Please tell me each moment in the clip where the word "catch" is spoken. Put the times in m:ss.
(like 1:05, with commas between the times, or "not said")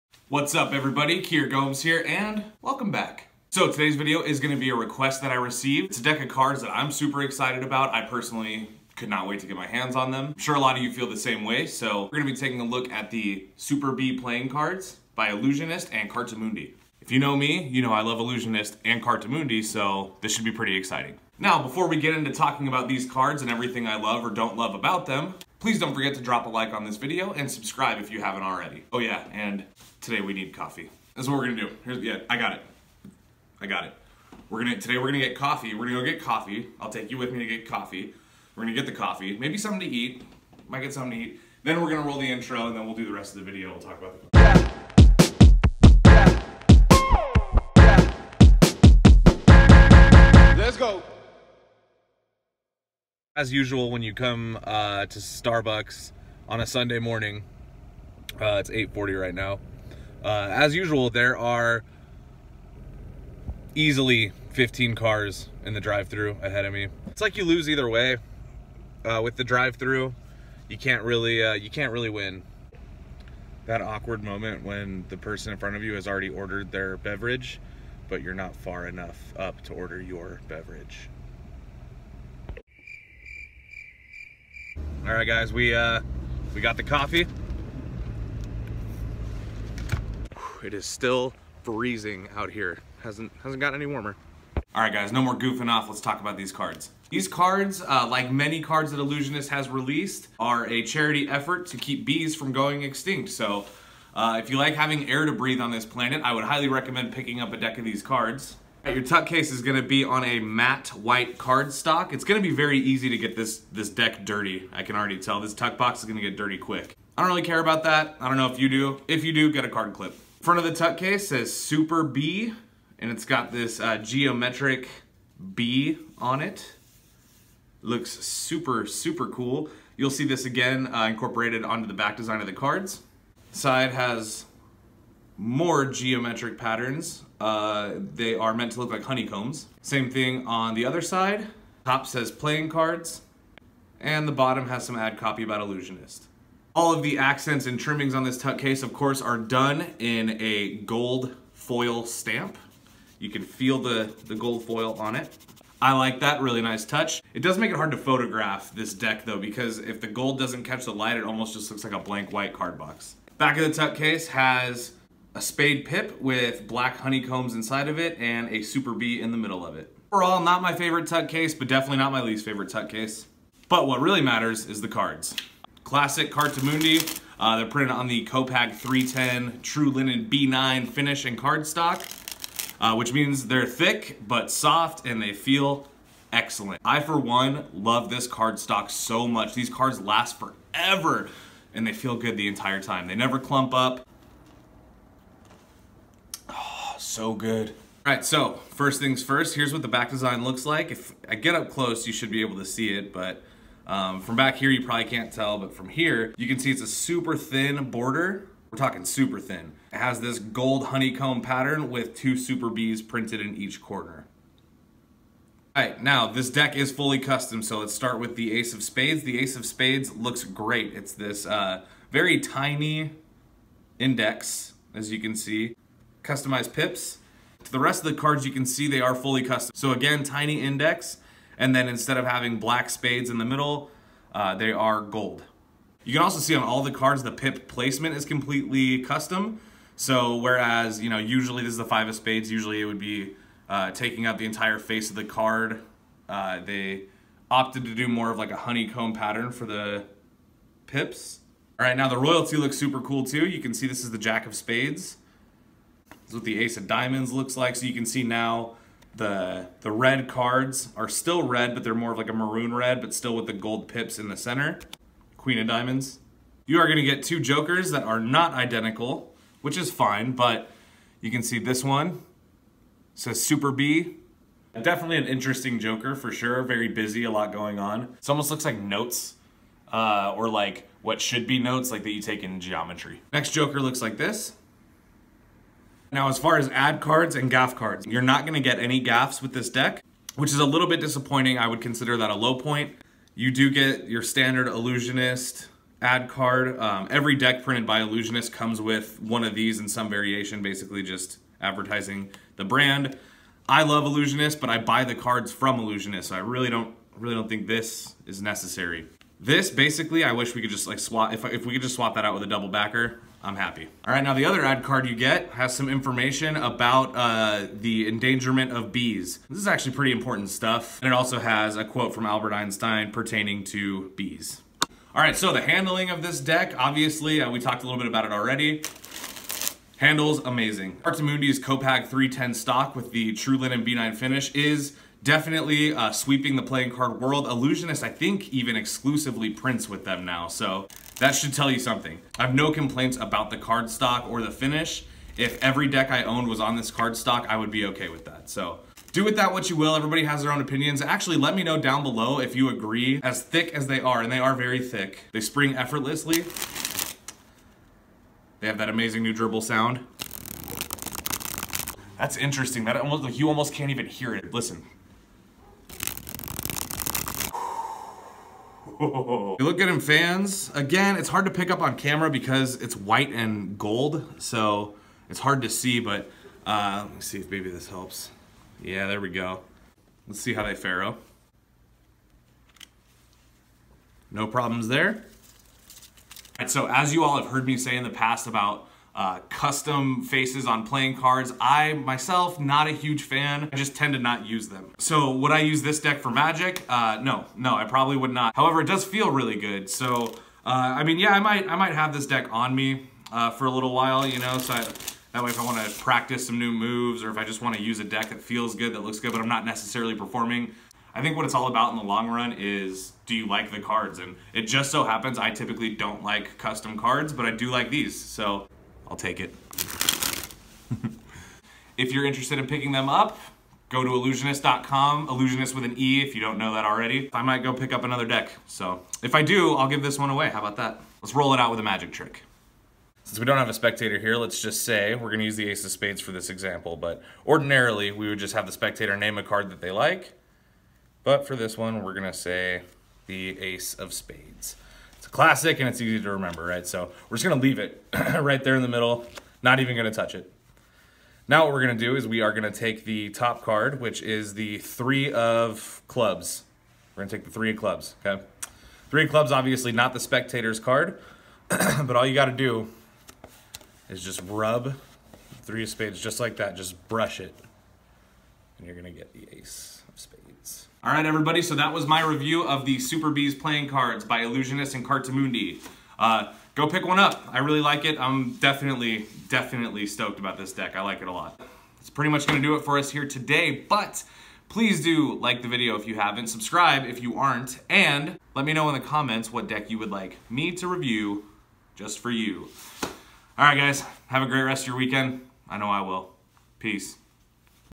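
2:40.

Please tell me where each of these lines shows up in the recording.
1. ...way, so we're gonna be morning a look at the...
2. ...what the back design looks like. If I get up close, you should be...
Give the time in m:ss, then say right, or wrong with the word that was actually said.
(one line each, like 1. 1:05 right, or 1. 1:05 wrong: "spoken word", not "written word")
1. 0:11 wrong: "taking", not "morning"
2. 3:19 right.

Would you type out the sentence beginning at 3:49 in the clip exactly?
So again, tiny index, and then instead of having black spades in the middle, uh, they are gold.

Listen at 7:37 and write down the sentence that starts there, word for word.
We're gonna take the three of clubs, okay?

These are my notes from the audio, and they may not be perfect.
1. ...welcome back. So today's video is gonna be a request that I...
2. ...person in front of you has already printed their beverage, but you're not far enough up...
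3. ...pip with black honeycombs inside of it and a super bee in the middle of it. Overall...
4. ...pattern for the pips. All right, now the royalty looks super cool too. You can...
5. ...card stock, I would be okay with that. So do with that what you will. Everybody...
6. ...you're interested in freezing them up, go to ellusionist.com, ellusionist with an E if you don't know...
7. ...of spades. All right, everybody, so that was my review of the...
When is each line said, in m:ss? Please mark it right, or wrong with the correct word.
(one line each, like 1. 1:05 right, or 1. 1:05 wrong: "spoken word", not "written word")
1. 0:02 right
2. 1:15 wrong: "ordered", not "printed"
3. 2:45 right
4. 4:09 right
5. 5:46 right
6. 7:02 wrong: "picking", not "freezing"
7. 7:50 right.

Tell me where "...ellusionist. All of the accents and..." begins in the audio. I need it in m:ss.
2:25.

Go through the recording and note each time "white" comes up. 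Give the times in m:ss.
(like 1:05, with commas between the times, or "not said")
1:50, 2:42, 6:12.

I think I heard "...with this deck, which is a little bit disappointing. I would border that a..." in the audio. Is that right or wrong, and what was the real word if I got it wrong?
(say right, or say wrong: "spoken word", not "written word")
wrong: "consider", not "border".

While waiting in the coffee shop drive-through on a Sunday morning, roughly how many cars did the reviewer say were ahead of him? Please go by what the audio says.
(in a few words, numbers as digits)
15.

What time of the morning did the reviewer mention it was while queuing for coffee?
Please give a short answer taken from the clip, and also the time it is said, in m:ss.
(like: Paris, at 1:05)
8:40, at 0:58.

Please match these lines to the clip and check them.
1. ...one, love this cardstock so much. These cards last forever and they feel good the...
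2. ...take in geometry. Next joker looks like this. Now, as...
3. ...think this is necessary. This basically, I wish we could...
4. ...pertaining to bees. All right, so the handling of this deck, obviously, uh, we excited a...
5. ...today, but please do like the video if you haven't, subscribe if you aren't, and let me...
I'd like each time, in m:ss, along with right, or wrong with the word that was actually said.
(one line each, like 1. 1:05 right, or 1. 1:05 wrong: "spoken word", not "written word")
1. 3:07 right
2. 4:42 right
3. 5:07 right
4. 5:23 wrong: "talked", not "excited"
5. 8:03 right.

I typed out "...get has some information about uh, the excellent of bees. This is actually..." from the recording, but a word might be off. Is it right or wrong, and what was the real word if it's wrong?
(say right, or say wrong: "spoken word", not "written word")
wrong: "endangerment", not "excellent".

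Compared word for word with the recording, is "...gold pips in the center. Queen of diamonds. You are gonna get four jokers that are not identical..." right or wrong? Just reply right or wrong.
wrong.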